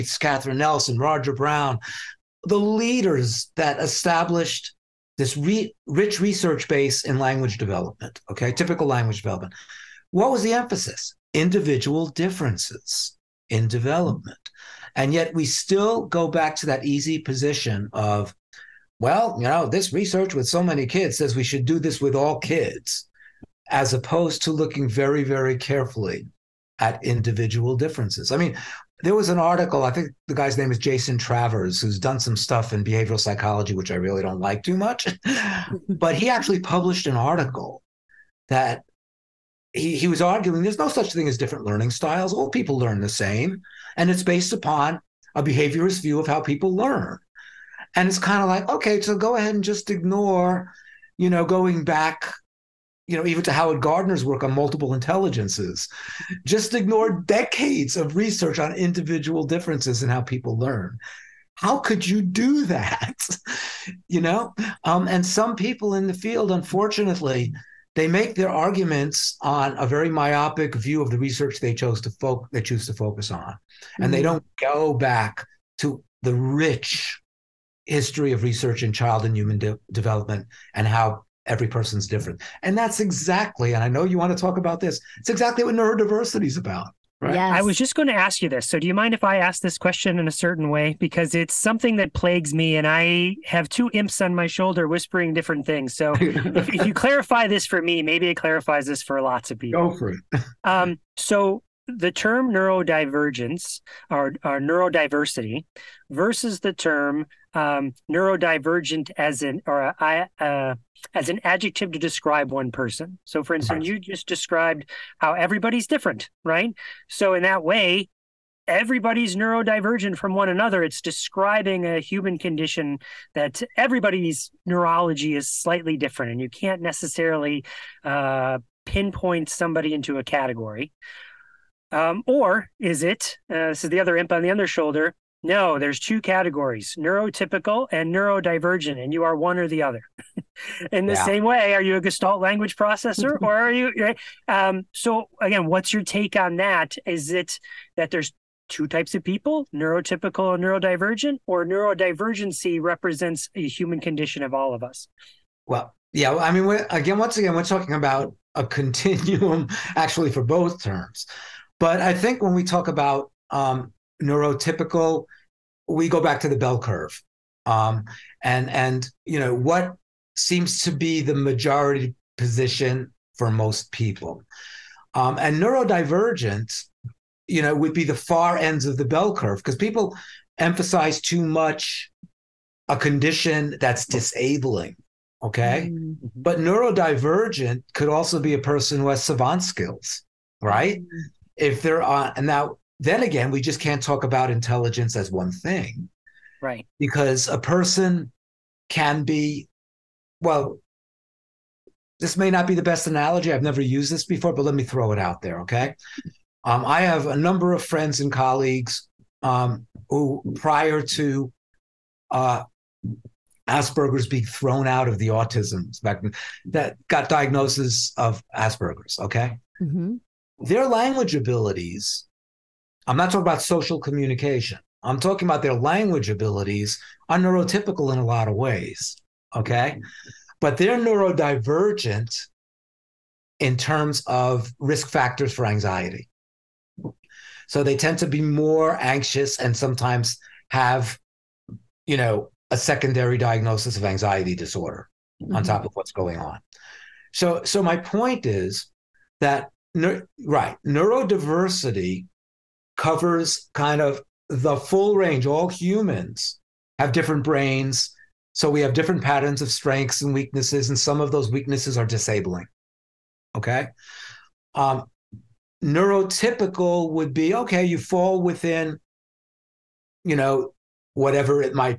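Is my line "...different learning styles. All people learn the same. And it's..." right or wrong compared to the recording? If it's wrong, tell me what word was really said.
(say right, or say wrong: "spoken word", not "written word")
right.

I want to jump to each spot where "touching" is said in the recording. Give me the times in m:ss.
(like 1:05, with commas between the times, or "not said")
not said.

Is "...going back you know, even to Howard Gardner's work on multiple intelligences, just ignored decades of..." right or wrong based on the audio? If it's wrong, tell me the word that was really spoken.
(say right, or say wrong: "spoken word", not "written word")
right.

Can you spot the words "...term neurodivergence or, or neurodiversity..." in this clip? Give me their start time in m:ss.
1:42.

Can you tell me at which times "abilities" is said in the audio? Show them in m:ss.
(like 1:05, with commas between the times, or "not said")
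3:41, 3:46.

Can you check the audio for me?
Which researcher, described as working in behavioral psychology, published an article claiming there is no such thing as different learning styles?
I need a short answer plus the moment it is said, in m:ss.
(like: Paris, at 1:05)
Jason Travers, at 0:30.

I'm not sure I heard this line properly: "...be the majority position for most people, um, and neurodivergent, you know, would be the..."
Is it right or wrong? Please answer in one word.
right.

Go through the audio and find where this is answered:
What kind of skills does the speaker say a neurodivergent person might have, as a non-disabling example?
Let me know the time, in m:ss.
3:09.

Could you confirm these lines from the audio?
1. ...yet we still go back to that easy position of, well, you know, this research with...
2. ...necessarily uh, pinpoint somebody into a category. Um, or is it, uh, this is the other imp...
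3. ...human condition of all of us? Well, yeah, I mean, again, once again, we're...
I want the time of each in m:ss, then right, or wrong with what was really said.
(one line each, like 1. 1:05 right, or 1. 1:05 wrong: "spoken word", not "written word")
1. 0:15 right
2. 2:06 right
3. 2:33 right.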